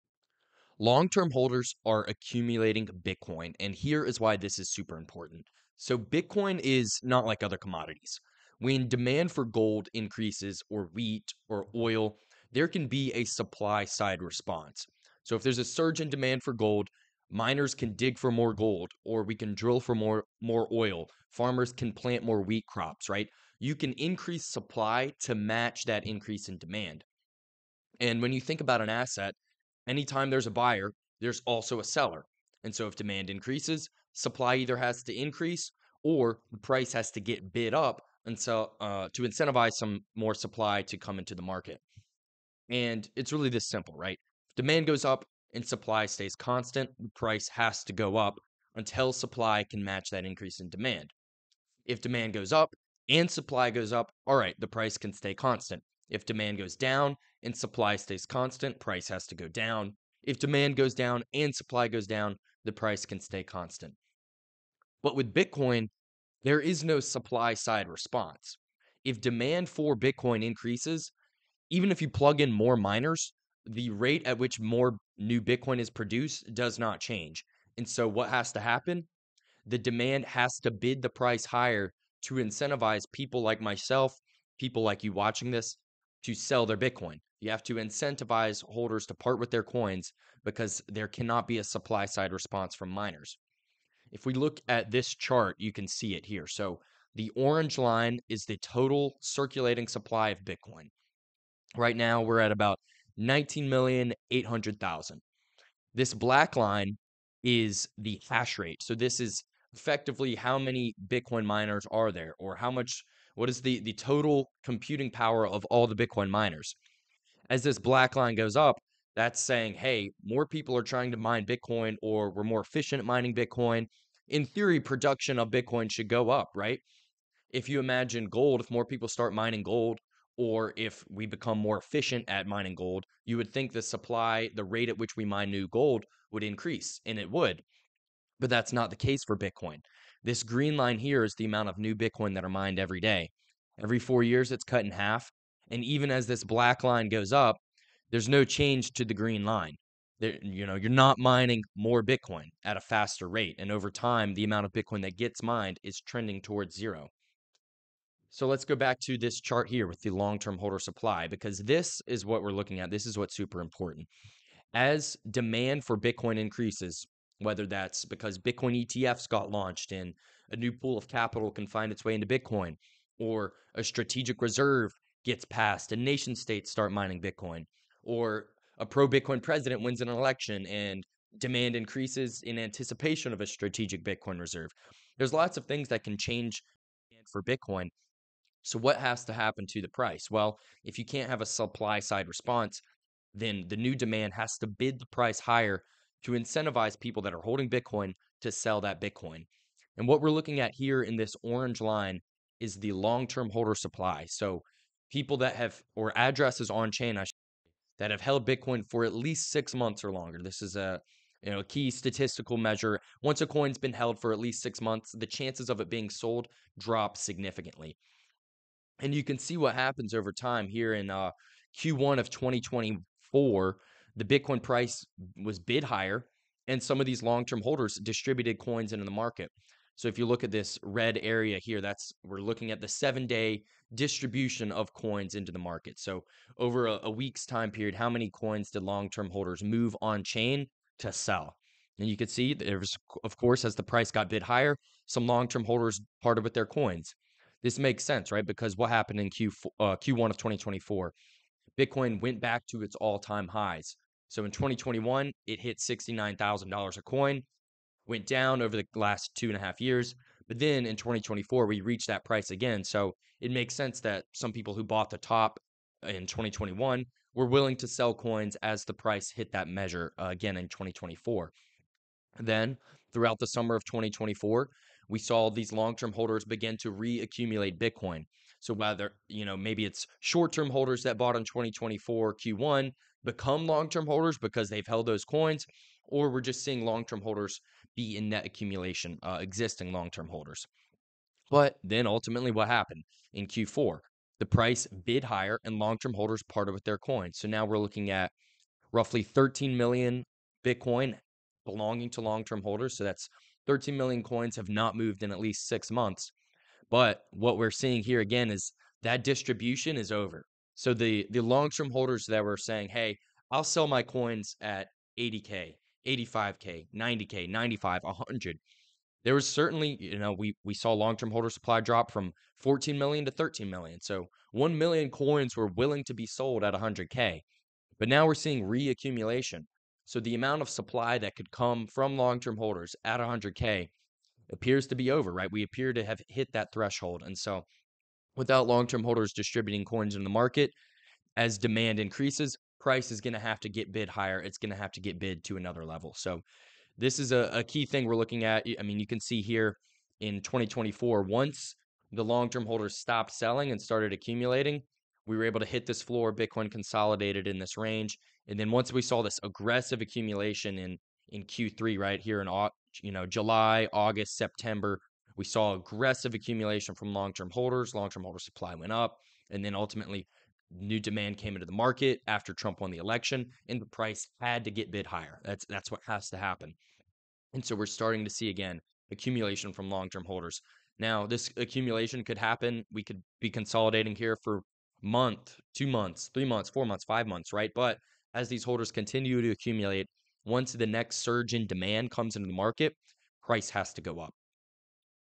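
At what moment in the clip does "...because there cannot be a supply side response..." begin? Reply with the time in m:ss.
1:30.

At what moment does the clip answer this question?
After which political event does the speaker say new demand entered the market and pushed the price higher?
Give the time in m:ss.
6:12.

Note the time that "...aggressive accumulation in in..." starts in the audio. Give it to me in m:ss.
5:59.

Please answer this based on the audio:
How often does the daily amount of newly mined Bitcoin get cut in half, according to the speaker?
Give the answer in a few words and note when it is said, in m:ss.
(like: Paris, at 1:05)
Every 4 years, at 2:23.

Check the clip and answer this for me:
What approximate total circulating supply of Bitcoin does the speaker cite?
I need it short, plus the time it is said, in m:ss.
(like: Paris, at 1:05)
19,800,000, at 1:43.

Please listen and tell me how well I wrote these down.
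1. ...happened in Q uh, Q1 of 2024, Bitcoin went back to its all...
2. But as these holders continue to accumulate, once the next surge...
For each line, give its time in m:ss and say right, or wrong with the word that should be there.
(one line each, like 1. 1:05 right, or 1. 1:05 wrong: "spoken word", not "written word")
1. 4:08 right
2. 6:27 right.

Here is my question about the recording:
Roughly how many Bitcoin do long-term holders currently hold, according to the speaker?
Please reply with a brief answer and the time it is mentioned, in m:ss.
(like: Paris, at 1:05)
13 million, at 4:58.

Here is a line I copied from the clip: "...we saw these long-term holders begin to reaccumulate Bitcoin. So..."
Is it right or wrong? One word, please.
right.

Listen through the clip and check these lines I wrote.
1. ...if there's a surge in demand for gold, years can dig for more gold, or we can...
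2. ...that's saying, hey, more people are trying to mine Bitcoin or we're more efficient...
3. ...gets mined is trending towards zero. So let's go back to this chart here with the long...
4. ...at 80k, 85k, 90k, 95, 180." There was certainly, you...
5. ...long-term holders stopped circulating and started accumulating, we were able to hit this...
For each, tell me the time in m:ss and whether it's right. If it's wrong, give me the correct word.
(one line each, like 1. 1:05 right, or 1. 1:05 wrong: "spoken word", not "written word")
1. 0:15 wrong: "miners", not "years"
2. 1:59 right
3. 2:35 right
4. 5:14 wrong: "100", not "180"
5. 5:52 wrong: "selling", not "circulating".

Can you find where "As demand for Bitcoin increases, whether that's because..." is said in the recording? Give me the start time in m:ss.
2:44.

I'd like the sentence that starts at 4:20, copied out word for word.
But then in 2024, we reached that price again.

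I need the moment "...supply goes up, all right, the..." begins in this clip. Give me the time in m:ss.
0:53.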